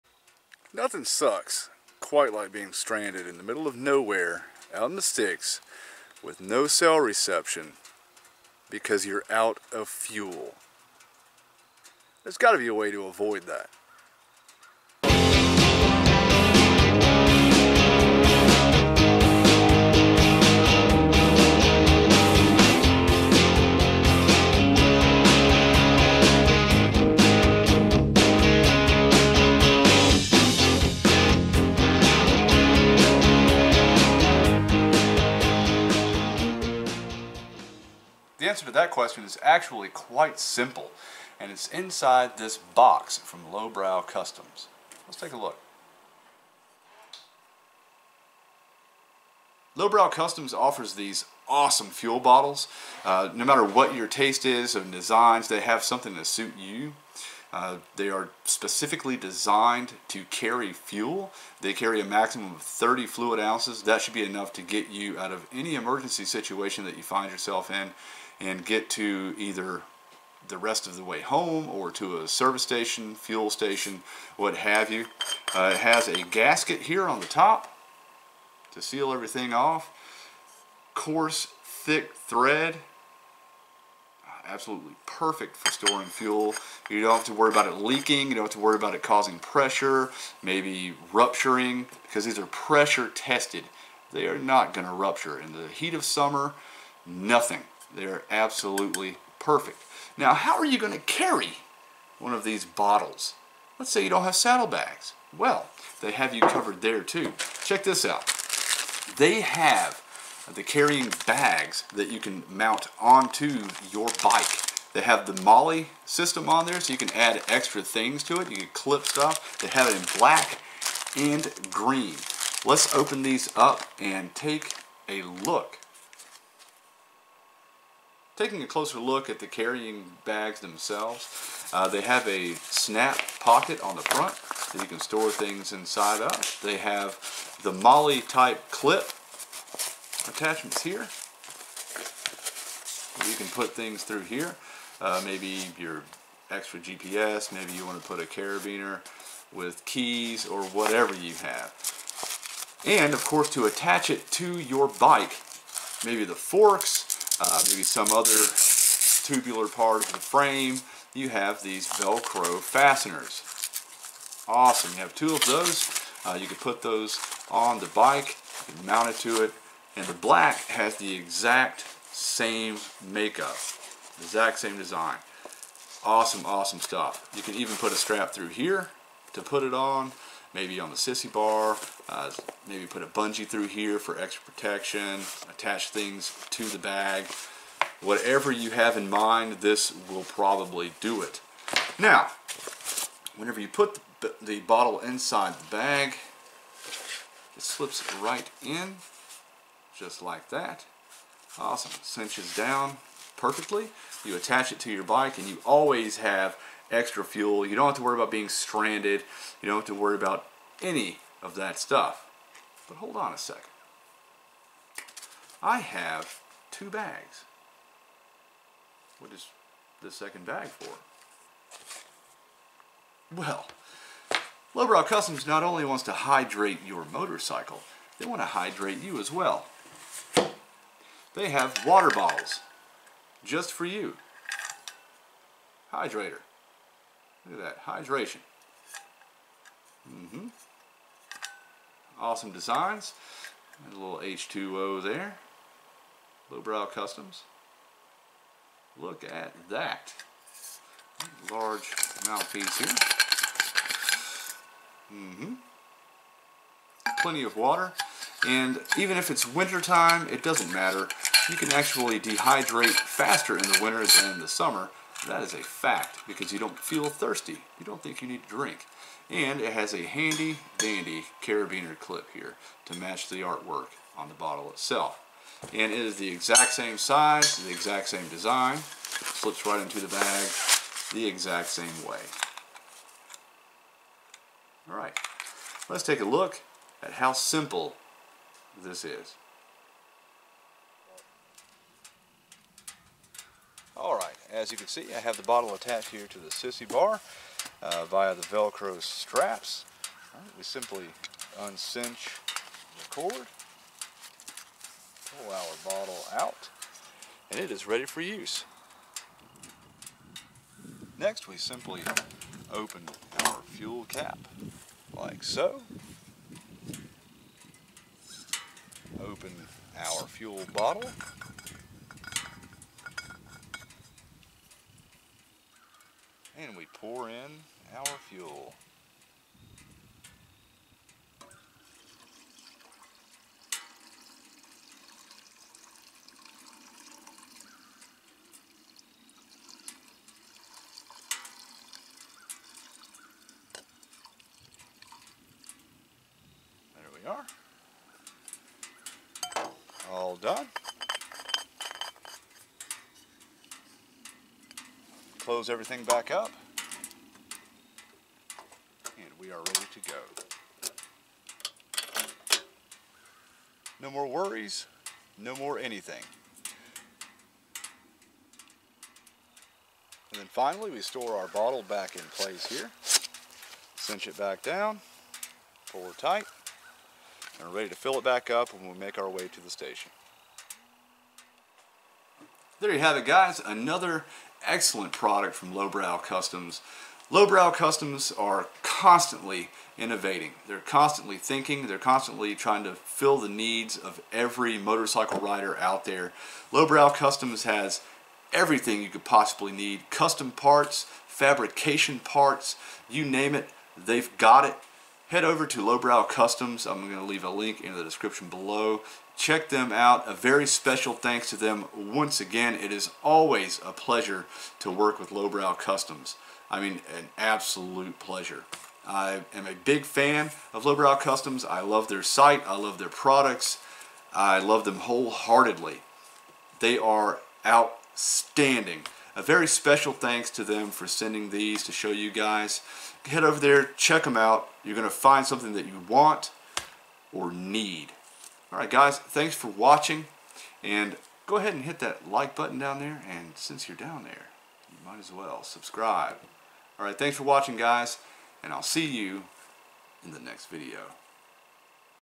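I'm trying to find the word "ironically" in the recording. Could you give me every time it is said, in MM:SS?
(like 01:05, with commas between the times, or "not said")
not said.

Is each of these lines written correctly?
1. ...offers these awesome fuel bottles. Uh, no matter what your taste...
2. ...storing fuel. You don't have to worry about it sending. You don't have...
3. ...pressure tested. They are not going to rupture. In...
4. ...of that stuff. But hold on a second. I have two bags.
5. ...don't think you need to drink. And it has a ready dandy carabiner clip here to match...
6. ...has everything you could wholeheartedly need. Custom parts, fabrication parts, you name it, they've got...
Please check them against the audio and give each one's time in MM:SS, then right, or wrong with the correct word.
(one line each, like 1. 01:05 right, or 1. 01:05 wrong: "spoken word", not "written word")
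1. 00:50 right
2. 01:25 wrong: "leaking", not "sending"
3. 01:32 right
4. 03:31 right
5. 04:27 wrong: "handy", not "ready"
6. 06:37 wrong: "possibly", not "wholeheartedly".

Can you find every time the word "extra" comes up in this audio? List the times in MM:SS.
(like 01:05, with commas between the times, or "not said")
01:57, 02:26, 03:04, 03:26.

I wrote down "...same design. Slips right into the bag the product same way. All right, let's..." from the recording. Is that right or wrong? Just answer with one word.
wrong.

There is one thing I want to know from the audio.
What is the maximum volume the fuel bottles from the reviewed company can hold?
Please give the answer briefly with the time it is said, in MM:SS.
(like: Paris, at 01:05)
30 fluid ounces, at 01:02.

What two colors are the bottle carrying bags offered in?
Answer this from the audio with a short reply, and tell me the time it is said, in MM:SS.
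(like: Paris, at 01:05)
Black and green, at 02:00.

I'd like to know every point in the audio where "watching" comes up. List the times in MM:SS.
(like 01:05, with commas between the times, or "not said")
07:19, 07:27.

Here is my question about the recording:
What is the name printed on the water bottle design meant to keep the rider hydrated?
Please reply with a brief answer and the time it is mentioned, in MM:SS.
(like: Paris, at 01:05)
Hydrator, at 03:55.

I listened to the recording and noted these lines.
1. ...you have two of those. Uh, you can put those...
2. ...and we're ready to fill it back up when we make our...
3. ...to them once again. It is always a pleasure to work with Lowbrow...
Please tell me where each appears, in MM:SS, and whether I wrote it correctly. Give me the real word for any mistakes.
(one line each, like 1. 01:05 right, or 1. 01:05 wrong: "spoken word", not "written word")
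1. 02:44 right
2. 06:17 right
3. 06:51 right.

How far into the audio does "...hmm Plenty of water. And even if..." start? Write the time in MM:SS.
04:15.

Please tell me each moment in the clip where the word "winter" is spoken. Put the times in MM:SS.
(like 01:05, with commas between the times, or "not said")
04:19, 04:23.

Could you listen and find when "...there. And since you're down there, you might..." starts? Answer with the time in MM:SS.
07:22.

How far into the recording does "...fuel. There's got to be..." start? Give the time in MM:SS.
00:09.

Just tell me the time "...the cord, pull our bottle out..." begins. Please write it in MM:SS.
05:03.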